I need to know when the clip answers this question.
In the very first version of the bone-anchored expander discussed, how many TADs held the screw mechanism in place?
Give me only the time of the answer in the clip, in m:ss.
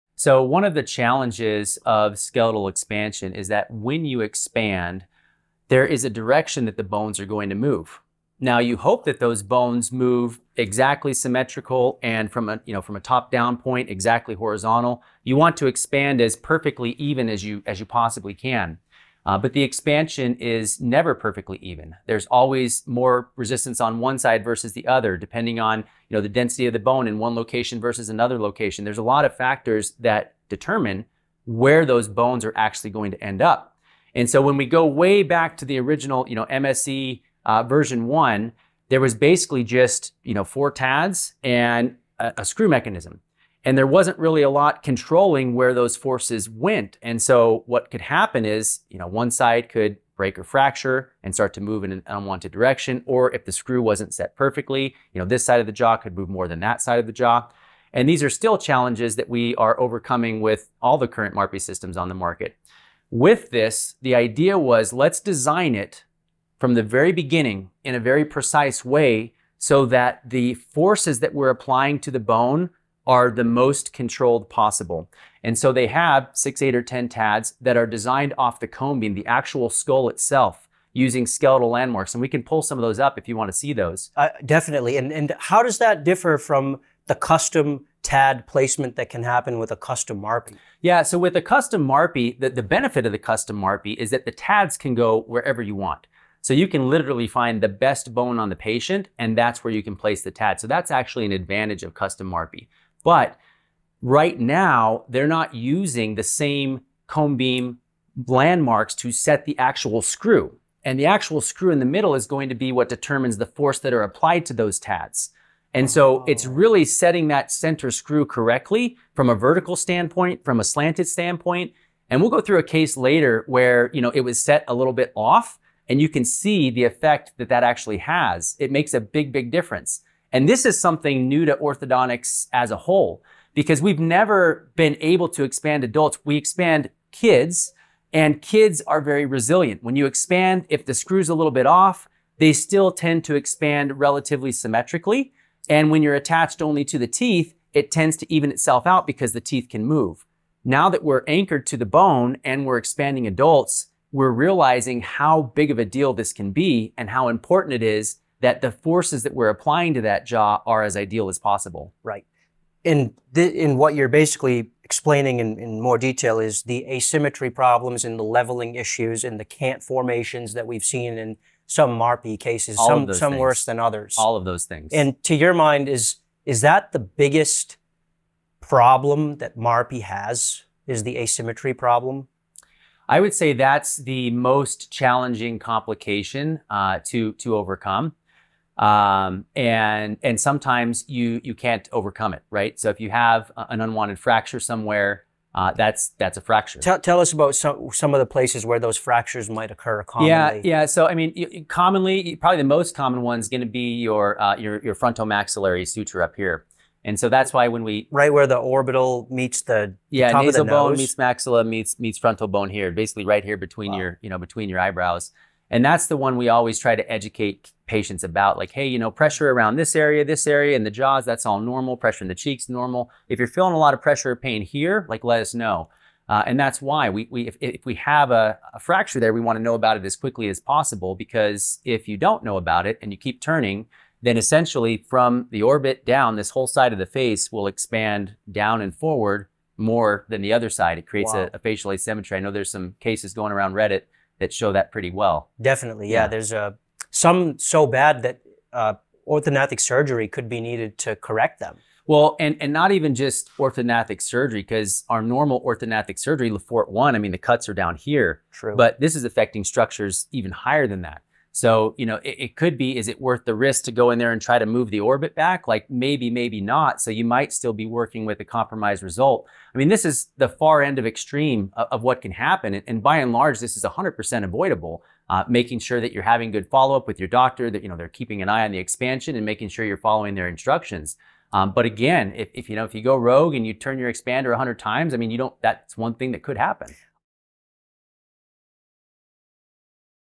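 0:40.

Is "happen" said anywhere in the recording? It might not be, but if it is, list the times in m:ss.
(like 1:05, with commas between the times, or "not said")
0:48, 1:29, 4:32, 4:46.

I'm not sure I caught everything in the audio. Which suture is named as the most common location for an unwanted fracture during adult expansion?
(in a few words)
frontomaxillary suture.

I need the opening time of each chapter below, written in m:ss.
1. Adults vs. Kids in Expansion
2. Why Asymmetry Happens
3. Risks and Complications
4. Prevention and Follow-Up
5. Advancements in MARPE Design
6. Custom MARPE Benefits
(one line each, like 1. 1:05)
1. 2:10
2. 0:22
3. 2:53
4. 4:05
5. 0:43
6. 1:10.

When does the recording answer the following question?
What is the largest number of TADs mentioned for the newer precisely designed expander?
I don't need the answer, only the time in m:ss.
1:16.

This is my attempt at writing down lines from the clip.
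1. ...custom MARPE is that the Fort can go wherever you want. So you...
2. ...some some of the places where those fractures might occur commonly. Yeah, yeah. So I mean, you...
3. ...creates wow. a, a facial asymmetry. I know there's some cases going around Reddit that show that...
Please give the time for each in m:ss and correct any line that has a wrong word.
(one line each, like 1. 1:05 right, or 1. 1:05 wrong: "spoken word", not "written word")
1. 1:33 wrong: "TADs", not "Fort"
2. 3:17 right
3. 4:01 right.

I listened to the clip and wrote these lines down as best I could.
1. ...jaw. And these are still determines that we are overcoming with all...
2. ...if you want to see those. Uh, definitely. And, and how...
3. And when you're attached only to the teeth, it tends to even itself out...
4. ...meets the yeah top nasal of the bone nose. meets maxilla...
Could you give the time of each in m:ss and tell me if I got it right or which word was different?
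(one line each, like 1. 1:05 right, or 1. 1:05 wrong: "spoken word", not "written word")
1. 0:57 wrong: "challenges", not "determines"
2. 1:23 right
3. 2:25 right
4. 3:29 right.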